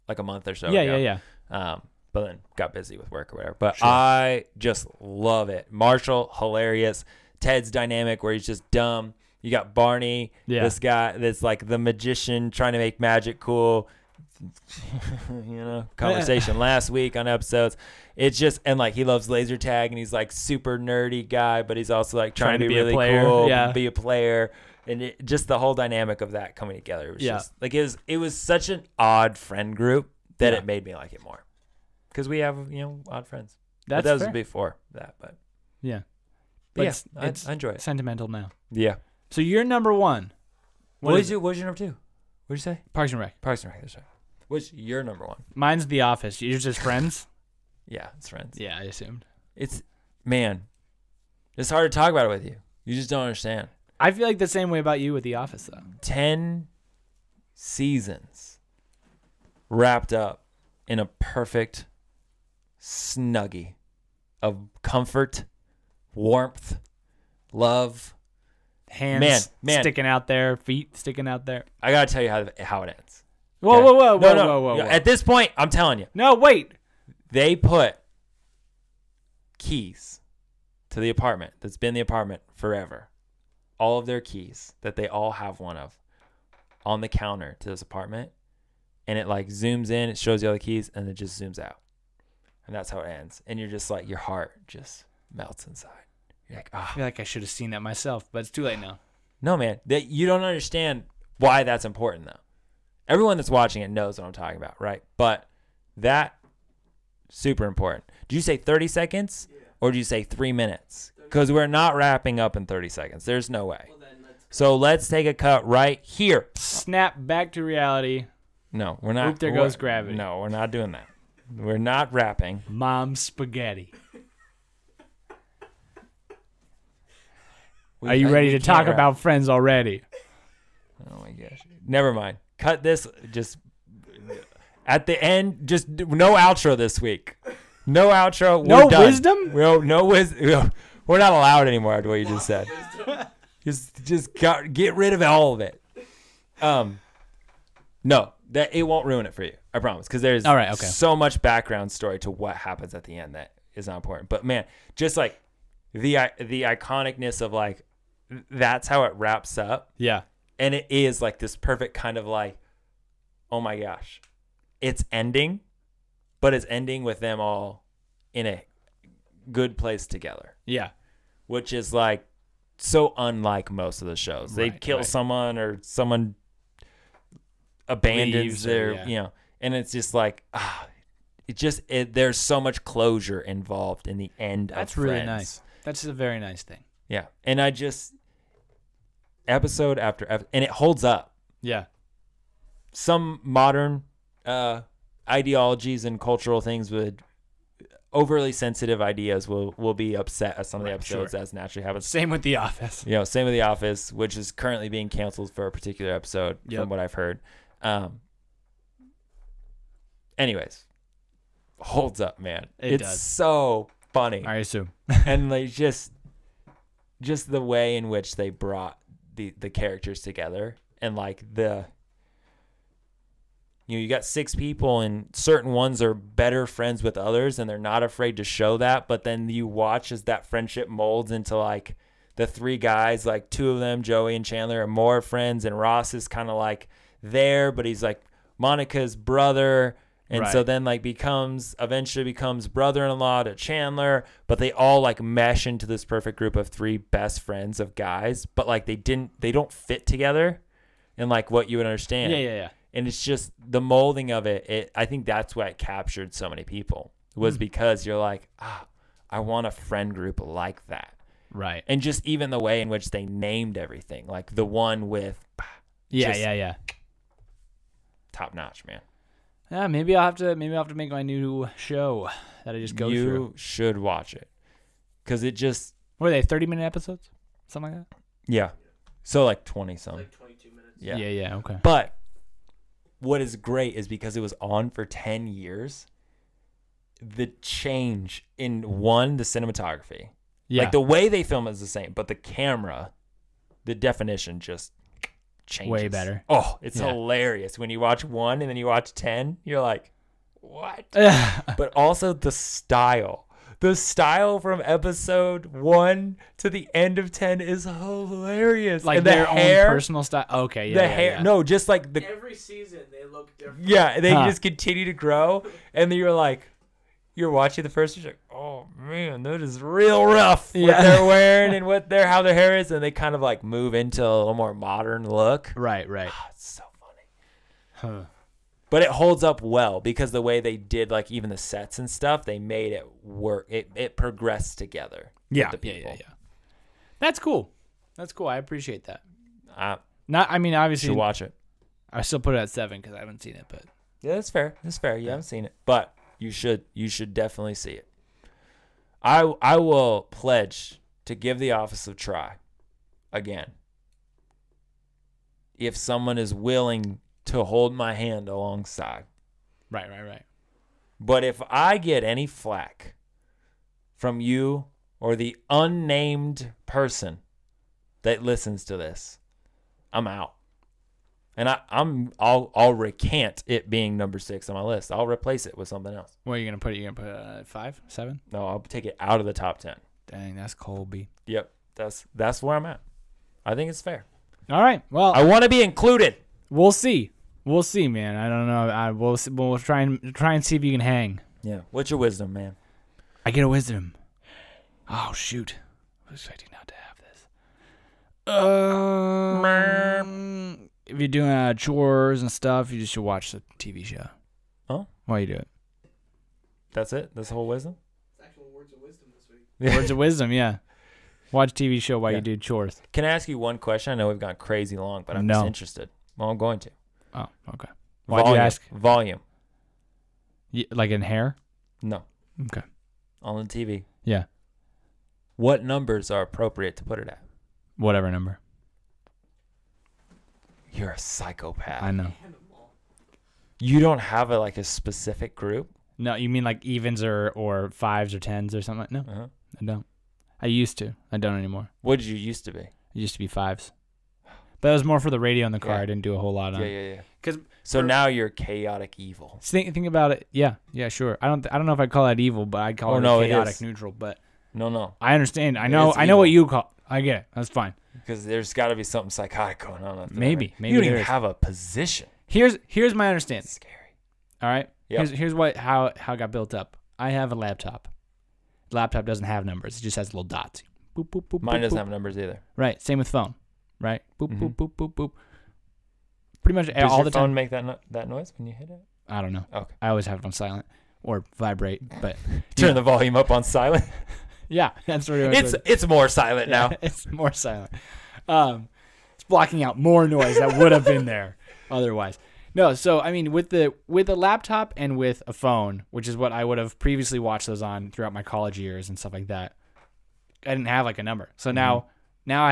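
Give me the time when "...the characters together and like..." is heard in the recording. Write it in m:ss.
3:39.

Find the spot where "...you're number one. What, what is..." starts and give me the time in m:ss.
0:39.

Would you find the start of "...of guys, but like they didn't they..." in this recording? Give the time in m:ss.
4:07.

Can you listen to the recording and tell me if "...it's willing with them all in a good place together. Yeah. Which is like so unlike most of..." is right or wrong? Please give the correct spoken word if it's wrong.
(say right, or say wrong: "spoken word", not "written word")
wrong: "ending", not "willing".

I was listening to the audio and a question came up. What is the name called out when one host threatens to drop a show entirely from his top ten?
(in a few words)
Colby.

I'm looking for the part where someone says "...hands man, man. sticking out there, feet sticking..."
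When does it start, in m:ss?
1:08.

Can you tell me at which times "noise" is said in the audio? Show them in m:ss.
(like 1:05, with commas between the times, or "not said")
7:58, 8:10.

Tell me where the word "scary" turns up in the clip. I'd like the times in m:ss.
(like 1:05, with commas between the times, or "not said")
7:43.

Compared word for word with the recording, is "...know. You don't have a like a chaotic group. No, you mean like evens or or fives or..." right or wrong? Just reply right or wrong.
wrong.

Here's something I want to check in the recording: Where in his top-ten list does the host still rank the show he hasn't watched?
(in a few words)
7.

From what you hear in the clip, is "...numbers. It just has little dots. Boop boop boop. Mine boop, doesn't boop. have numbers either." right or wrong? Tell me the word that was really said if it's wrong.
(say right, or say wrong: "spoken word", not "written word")
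right.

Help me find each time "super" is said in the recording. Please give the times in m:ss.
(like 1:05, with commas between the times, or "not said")
0:20, 1:47.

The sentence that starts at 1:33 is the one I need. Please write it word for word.
And you're just like, your heart just melts inside like, ah.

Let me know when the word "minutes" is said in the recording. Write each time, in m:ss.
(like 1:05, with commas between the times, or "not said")
1:50, 4:36, 4:40.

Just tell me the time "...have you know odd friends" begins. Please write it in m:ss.
0:32.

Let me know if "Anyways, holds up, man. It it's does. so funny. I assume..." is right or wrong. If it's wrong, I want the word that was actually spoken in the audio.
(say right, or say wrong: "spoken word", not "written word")
right.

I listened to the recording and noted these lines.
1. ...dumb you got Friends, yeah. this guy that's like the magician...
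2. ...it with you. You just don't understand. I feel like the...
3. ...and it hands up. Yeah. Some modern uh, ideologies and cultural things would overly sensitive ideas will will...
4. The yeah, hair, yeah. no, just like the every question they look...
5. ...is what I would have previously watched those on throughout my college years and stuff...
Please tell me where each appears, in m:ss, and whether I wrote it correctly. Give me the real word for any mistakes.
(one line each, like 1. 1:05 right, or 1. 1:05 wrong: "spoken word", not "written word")
1. 0:08 wrong: "Barney", not "Friends"
2. 0:52 right
3. 3:10 wrong: "holds", not "hands"
4. 5:10 wrong: "season", not "question"
5. 8:16 right.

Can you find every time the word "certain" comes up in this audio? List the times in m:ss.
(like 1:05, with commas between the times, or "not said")
3:45.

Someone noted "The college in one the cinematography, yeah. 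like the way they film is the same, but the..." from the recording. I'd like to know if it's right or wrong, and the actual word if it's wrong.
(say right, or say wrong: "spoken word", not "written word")
wrong: "change", not "college".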